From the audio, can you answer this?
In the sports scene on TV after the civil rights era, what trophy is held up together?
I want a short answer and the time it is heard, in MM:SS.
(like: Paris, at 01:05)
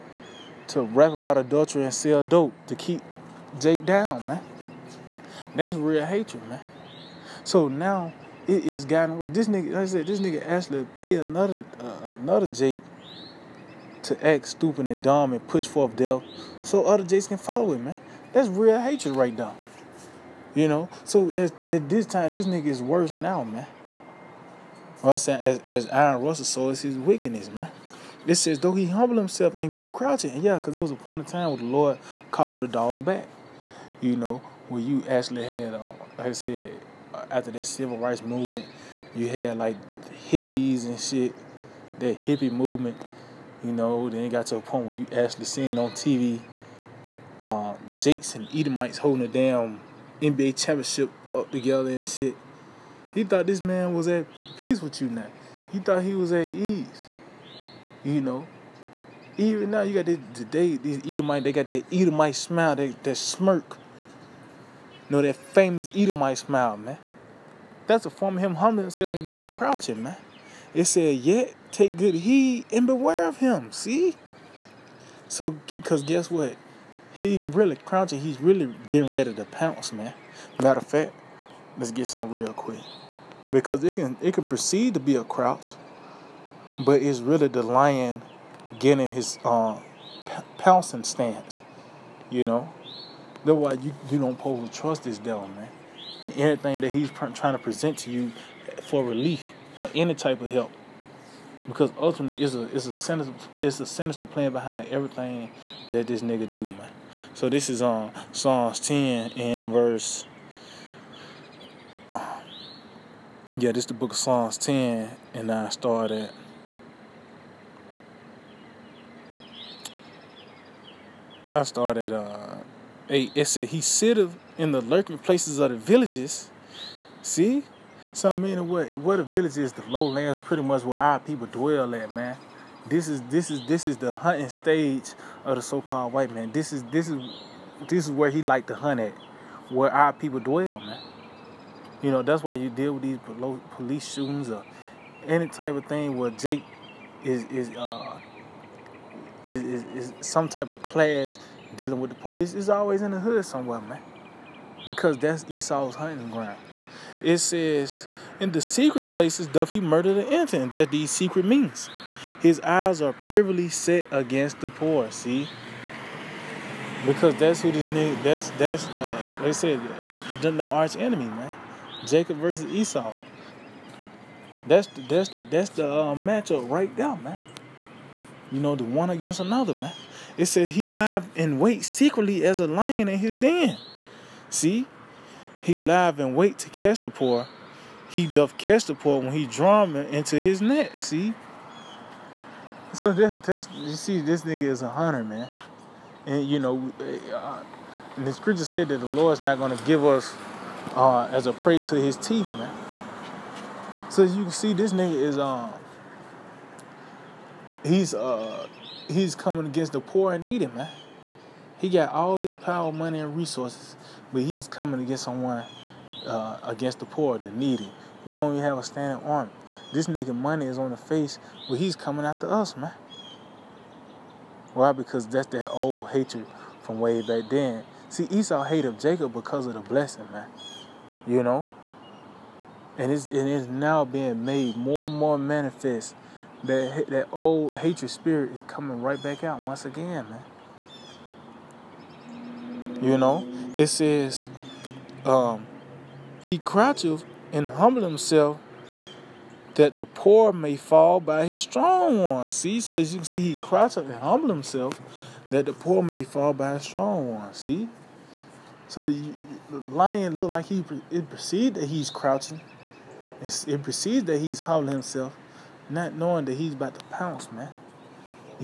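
NBA championship, at 00:50.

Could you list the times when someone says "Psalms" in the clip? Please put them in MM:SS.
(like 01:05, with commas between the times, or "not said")
01:48, 01:54.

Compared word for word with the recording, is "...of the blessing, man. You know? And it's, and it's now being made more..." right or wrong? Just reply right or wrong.
right.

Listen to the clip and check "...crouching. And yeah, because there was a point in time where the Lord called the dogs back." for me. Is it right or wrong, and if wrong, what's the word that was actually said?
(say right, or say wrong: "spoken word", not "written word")
right.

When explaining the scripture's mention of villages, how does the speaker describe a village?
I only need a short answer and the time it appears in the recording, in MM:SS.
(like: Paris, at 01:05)
the lowlands, at 02:09.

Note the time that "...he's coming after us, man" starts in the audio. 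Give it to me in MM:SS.
03:41.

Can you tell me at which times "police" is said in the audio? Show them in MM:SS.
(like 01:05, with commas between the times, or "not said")
02:23, 02:32.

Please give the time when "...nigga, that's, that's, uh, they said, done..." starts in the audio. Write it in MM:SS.
02:47.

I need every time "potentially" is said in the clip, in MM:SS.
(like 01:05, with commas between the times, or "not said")
not said.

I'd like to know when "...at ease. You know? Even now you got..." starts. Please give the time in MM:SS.
00:56.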